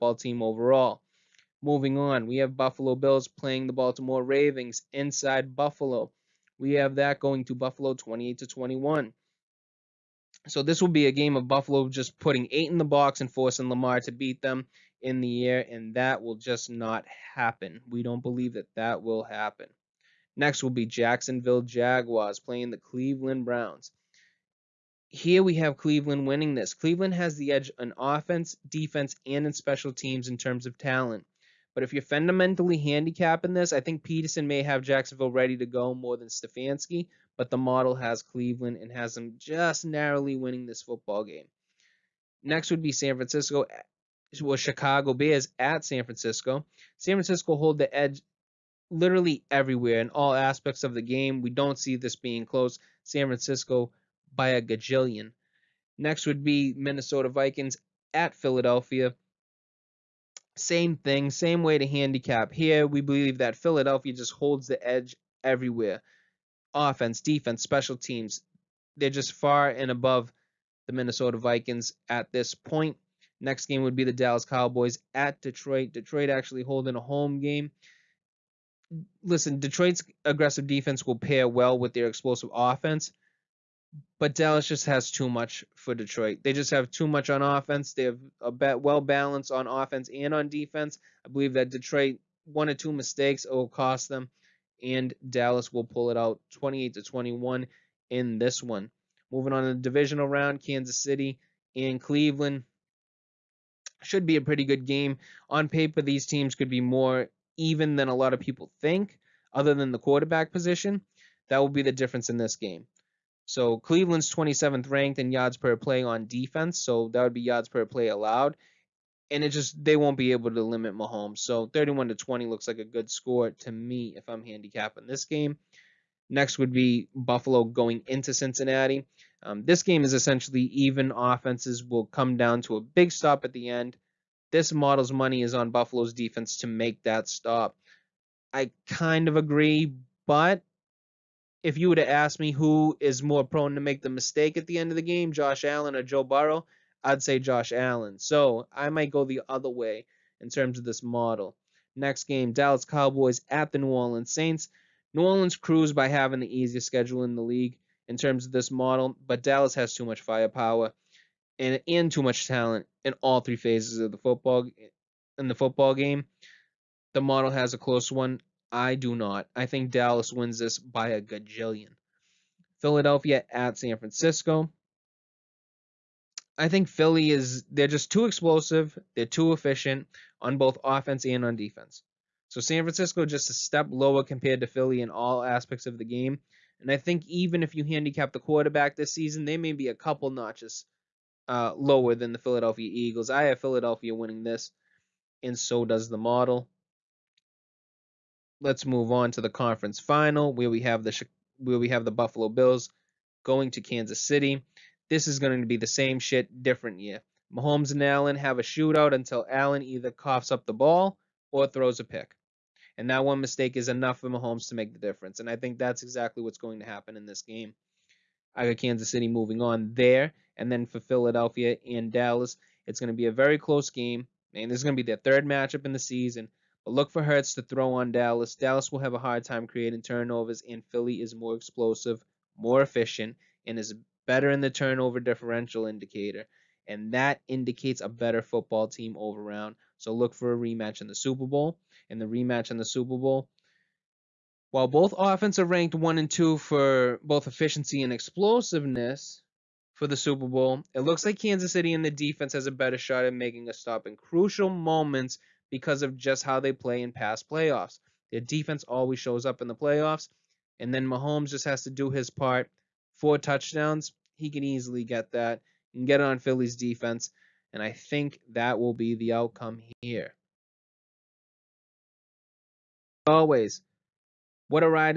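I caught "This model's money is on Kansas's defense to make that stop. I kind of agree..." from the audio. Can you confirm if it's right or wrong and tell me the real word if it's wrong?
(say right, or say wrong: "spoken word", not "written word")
wrong: "Buffalo", not "Kansas".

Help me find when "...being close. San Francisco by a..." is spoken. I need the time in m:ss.
0:52.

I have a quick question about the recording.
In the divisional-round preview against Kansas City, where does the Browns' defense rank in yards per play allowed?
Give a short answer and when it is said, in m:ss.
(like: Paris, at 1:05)
27th, at 1:54.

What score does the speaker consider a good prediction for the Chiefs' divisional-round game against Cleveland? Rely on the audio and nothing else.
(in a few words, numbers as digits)
31 to 20.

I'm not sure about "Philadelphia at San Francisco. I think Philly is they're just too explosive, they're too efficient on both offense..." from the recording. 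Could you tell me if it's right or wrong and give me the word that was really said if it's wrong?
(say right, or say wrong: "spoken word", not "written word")
right.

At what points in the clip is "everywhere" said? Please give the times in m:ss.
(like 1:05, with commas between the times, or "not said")
0:49, 1:05.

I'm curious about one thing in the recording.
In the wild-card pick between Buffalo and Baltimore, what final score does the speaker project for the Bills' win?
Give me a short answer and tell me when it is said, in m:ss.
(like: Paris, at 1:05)
28 to 21, at 0:07.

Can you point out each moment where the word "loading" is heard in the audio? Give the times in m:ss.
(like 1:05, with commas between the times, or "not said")
not said.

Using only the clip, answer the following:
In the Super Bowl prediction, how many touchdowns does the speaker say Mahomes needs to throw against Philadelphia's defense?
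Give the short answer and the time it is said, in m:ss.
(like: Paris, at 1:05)
4, at 4:23.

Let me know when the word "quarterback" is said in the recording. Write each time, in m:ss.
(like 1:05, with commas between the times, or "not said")
1:49, 3:08.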